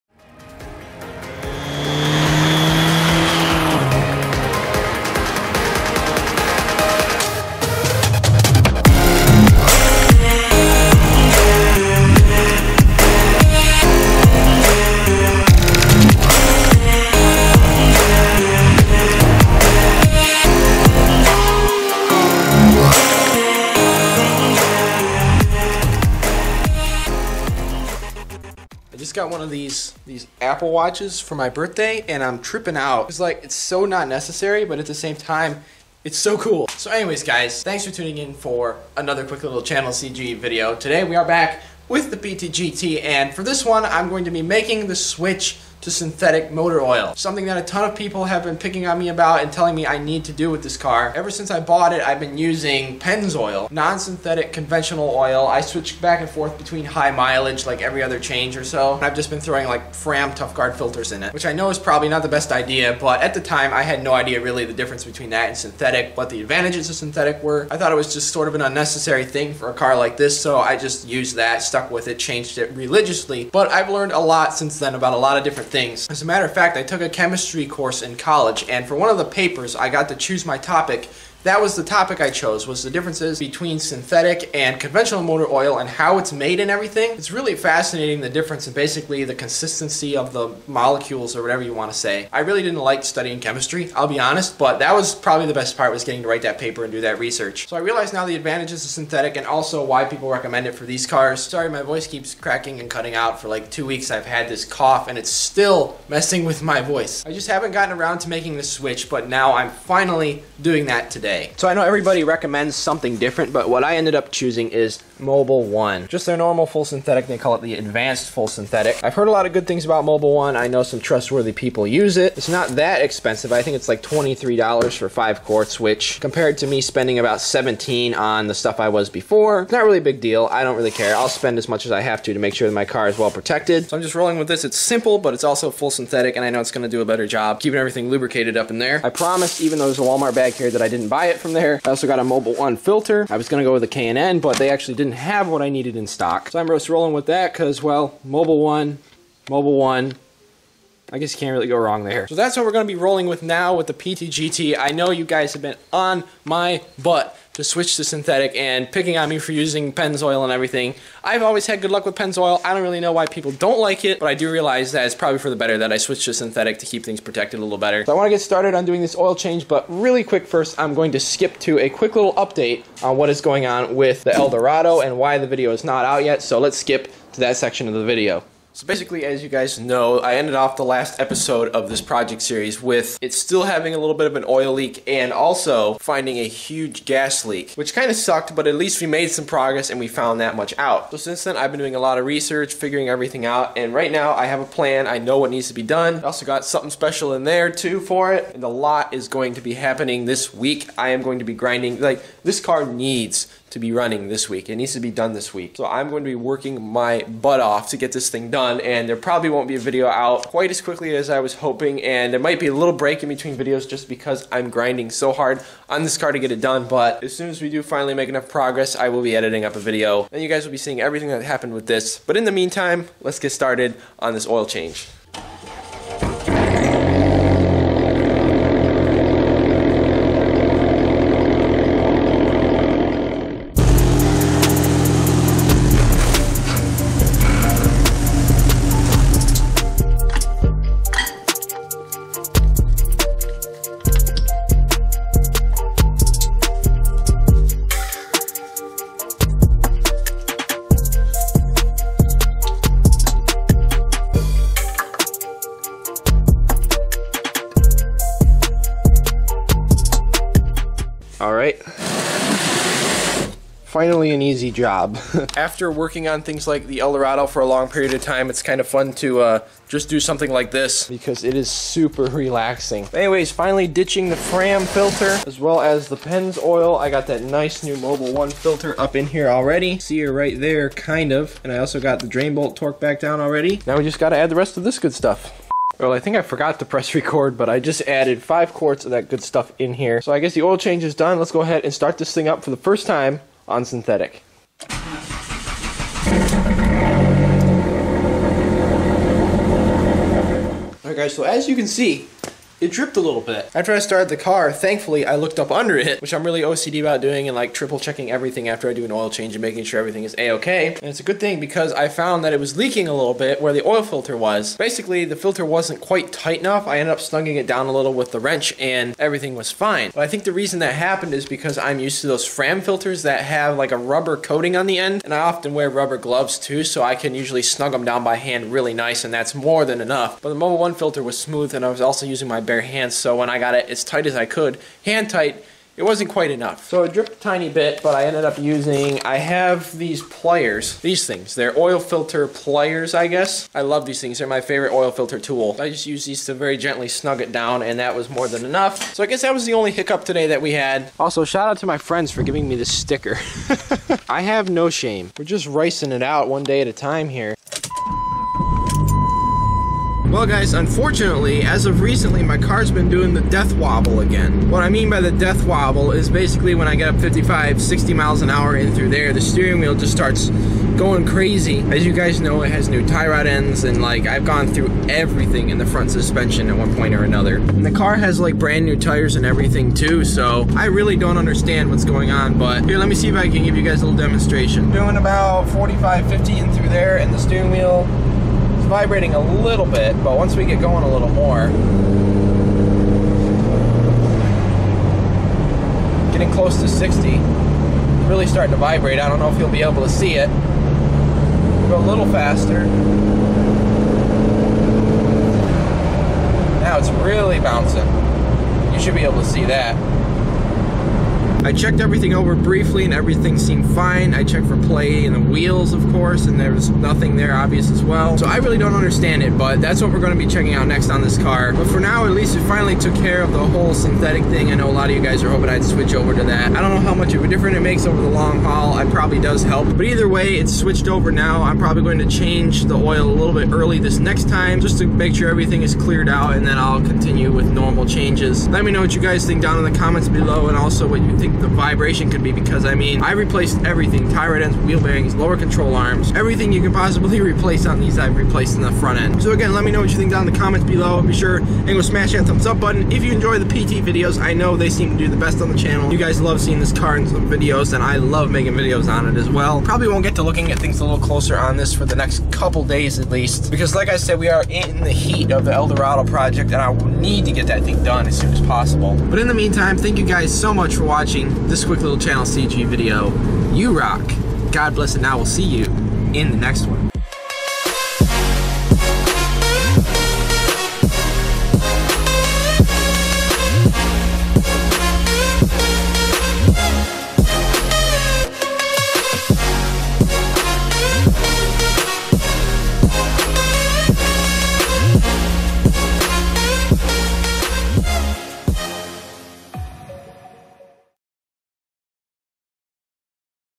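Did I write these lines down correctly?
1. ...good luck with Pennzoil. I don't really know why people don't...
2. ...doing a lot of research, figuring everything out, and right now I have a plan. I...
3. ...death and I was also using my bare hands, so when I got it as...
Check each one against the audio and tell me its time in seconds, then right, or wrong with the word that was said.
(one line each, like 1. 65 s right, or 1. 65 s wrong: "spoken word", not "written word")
1. 161 s right
2. 191 s right
3. 331 s wrong: "smooth", not "death".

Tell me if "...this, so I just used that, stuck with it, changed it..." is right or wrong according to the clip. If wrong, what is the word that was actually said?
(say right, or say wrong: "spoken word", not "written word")
right.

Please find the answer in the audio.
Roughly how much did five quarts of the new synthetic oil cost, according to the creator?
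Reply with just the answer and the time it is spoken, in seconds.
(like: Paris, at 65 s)
$23, at 124 s.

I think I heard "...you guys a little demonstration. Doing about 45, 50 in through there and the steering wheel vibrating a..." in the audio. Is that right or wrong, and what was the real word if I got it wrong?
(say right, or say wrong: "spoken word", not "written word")
right.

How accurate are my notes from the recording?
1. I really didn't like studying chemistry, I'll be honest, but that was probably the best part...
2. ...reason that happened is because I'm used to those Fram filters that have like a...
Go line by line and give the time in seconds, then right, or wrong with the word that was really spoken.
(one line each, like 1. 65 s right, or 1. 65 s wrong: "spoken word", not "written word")
1. 92 s right
2. 320 s right.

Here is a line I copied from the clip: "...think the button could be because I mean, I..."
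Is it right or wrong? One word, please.
wrong.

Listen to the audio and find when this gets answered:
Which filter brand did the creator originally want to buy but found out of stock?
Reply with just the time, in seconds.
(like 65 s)
143 s.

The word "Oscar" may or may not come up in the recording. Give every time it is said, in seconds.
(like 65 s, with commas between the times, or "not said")
not said.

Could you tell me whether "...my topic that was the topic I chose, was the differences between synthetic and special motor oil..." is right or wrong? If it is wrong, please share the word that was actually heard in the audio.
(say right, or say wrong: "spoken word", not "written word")
wrong: "conventional", not "special".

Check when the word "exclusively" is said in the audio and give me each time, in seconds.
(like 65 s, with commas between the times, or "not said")
not said.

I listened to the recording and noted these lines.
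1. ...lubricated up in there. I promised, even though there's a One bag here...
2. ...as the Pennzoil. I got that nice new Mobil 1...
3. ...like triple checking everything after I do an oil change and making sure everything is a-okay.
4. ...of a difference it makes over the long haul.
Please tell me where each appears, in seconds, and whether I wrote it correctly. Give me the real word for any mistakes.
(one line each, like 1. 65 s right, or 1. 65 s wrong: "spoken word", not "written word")
1. 138 s wrong: "Walmart", not "One"
2. 275 s right
3. 307 s right
4. 427 s right.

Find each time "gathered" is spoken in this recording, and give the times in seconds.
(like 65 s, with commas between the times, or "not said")
not said.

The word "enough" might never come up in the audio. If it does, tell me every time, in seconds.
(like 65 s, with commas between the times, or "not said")
218 s, 316 s, 330 s, 336 s, 348 s.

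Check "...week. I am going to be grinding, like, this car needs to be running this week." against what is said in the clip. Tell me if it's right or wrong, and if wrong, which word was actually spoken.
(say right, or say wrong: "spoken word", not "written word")
right.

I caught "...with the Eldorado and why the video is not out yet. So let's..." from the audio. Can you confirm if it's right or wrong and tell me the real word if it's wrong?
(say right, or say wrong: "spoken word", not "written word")
right.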